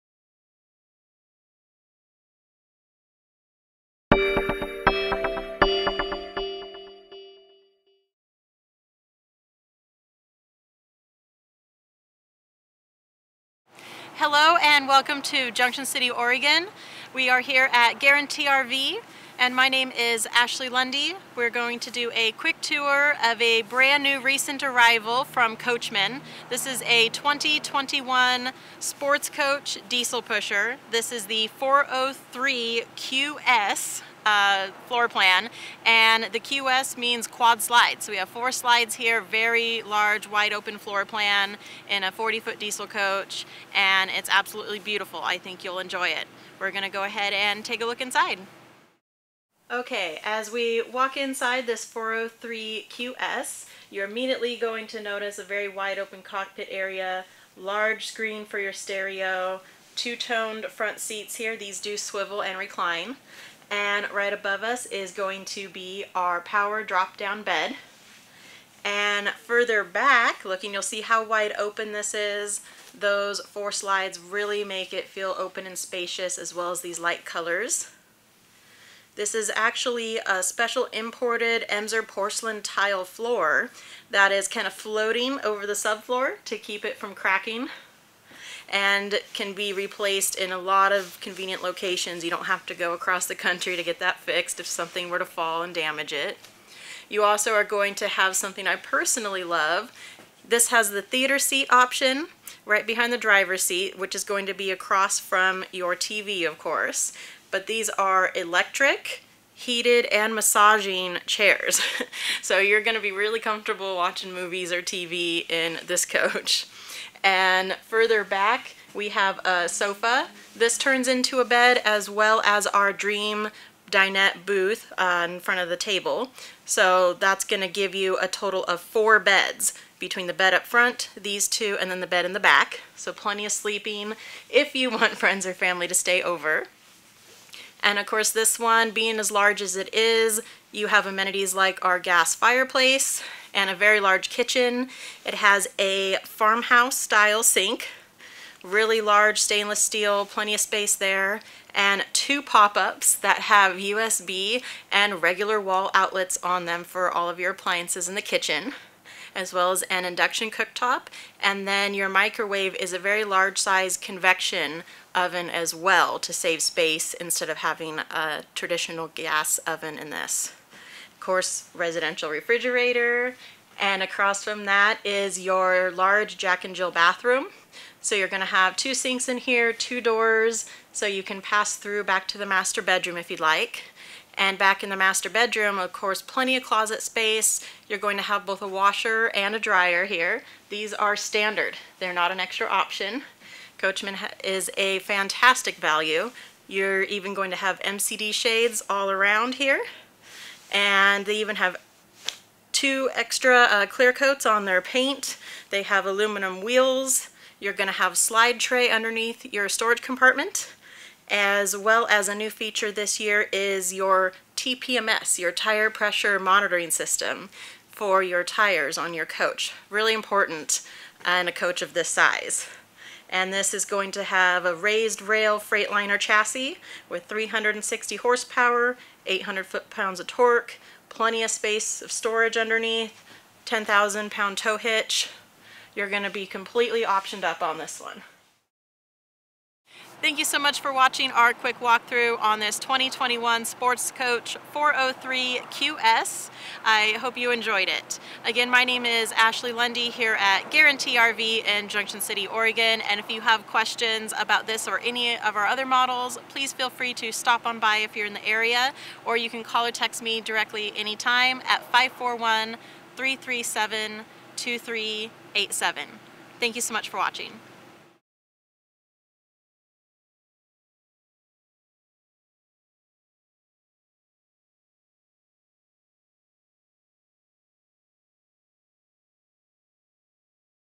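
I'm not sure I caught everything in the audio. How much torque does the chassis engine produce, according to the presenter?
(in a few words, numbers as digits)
800 foot-pounds.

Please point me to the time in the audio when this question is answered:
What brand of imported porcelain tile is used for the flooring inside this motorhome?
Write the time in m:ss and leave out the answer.
1:21.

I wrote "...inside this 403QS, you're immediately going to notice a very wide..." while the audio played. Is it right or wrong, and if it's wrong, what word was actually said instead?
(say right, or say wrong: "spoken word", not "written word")
right.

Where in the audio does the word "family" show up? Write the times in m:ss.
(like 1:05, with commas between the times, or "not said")
2:15.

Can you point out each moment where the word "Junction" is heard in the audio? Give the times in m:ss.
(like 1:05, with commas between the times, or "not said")
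0:15, 4:11.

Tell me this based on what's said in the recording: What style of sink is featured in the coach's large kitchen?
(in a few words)
Farmhouse style.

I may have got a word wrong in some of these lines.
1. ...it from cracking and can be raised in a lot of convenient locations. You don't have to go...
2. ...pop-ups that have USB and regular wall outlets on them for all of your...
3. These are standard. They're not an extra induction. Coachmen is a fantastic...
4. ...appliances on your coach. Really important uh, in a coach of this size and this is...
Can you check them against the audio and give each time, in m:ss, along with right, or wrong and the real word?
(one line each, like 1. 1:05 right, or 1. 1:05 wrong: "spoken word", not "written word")
1. 1:26 wrong: "replaced", not "raised"
2. 2:32 right
3. 3:10 wrong: "option", not "induction"
4. 3:38 wrong: "tires", not "appliances".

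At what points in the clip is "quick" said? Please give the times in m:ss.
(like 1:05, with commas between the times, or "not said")
0:22, 4:01.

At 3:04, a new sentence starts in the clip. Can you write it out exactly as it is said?
And back in the master bedroom, of course, plenty of closet space.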